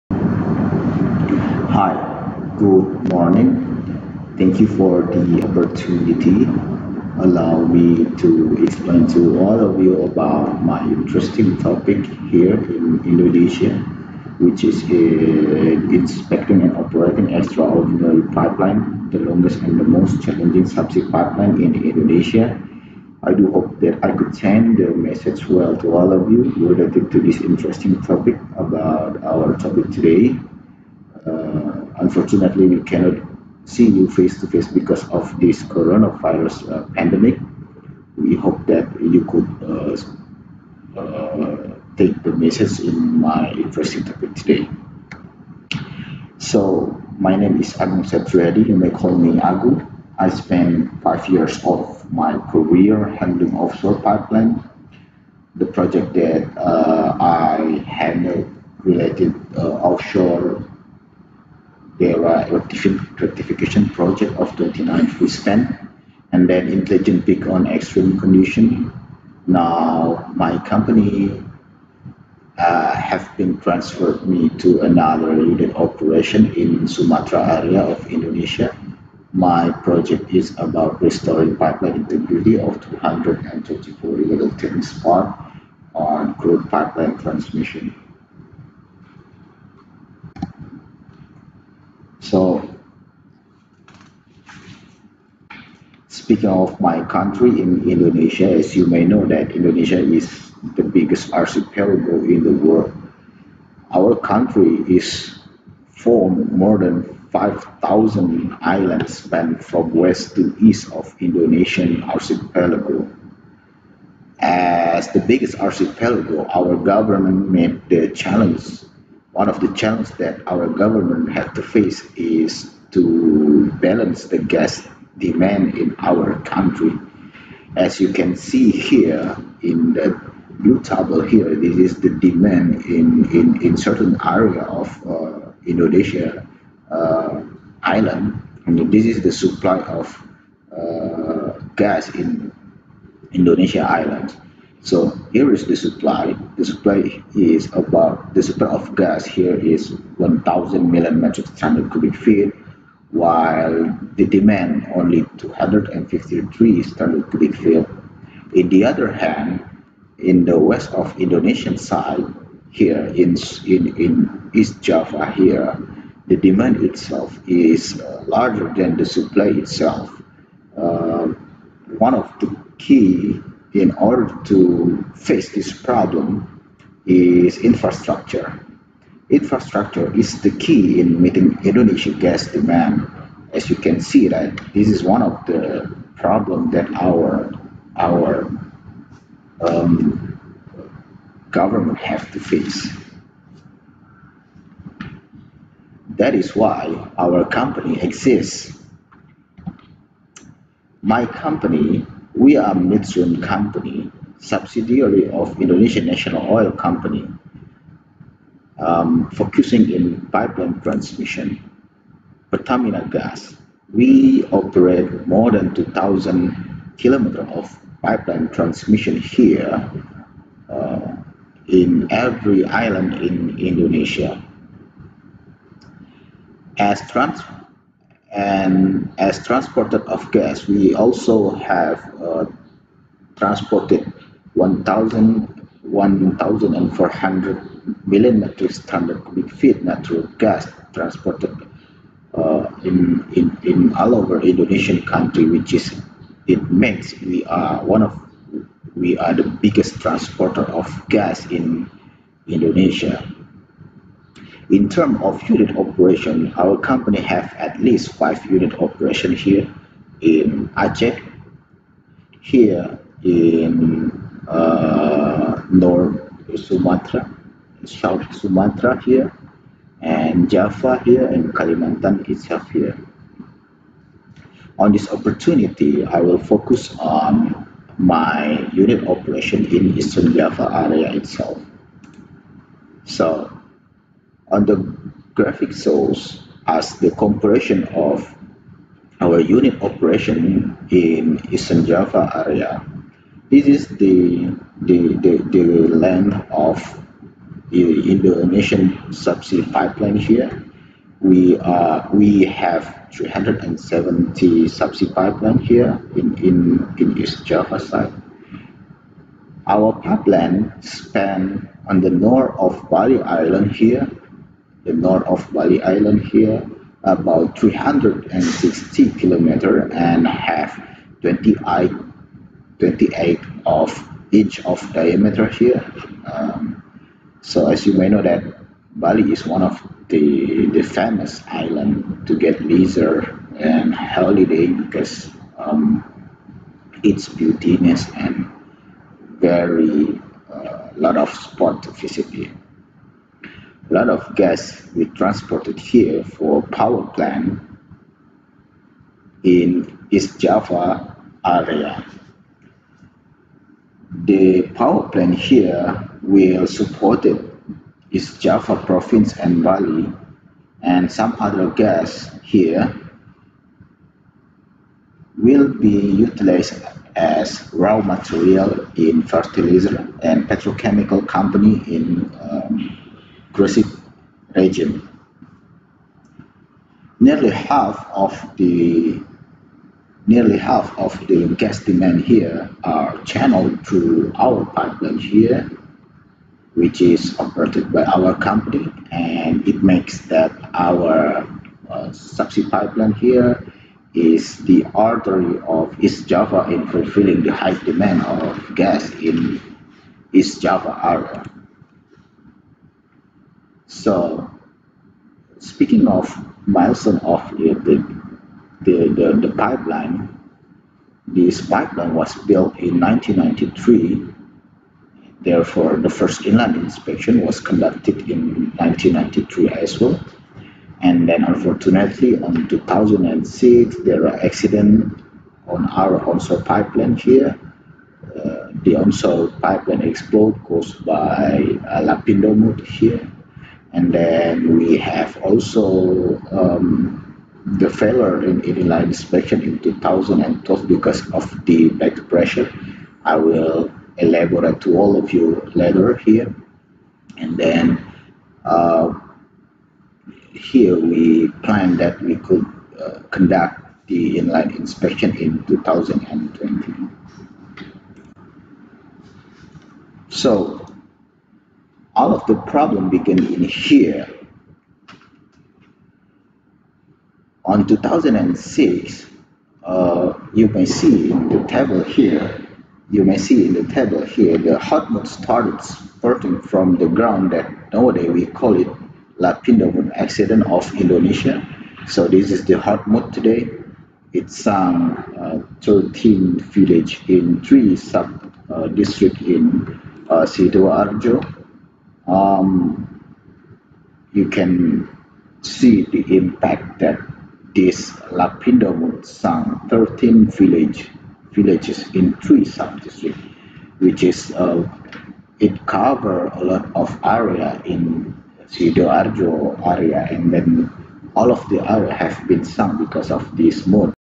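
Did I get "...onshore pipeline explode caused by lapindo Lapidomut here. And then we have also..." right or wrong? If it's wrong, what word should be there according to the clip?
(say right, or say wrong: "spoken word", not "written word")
right.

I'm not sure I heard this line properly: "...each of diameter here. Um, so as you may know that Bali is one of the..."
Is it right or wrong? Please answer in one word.
right.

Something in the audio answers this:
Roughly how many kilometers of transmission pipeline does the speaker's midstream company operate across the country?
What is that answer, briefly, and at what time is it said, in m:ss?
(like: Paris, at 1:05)
more than 2,000, at 3:35.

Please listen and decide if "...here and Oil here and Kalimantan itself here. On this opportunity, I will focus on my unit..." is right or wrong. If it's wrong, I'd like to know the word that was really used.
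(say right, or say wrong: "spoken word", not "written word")
wrong: "Java", not "Oil".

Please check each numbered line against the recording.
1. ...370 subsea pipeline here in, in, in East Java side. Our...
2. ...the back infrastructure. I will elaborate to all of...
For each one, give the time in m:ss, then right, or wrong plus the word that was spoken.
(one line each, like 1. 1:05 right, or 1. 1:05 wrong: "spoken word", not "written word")
1. 5:03 right
2. 7:21 wrong: "pressure", not "infrastructure".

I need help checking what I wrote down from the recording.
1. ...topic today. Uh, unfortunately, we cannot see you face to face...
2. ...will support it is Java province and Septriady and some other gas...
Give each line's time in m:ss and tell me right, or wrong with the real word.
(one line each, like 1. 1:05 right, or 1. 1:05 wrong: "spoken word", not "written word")
1. 0:29 right
2. 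5:56 wrong: "Bali", not "Septriady".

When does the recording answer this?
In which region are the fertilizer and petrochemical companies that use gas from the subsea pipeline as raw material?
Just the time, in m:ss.
6:13.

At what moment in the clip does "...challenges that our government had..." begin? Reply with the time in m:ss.
1:59.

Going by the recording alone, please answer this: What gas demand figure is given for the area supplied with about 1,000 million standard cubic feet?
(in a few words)
253.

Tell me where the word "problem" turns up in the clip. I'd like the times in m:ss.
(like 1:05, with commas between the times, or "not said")
2:55, 3:06, 7:42.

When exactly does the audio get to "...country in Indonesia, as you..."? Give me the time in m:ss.
1:37.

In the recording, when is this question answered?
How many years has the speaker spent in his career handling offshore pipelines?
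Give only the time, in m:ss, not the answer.
0:51.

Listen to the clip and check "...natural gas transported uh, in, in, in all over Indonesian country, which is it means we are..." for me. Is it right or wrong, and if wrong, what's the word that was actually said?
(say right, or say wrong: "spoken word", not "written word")
right.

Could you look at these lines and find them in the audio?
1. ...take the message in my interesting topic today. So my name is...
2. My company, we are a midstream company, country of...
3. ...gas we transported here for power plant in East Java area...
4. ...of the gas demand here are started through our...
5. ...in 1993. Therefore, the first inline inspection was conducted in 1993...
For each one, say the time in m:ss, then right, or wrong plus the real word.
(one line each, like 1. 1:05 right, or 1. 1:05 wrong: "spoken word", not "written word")
1. 0:41 right
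2. 3:21 wrong: "subsidiary", not "country"
3. 5:44 right
4. 6:20 wrong: "channeled", not "started"
5. 6:52 right.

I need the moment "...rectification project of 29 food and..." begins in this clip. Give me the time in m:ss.
1:02.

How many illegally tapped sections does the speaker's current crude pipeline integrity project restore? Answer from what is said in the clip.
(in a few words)
224.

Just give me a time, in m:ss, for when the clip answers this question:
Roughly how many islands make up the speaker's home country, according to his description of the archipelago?
1:46.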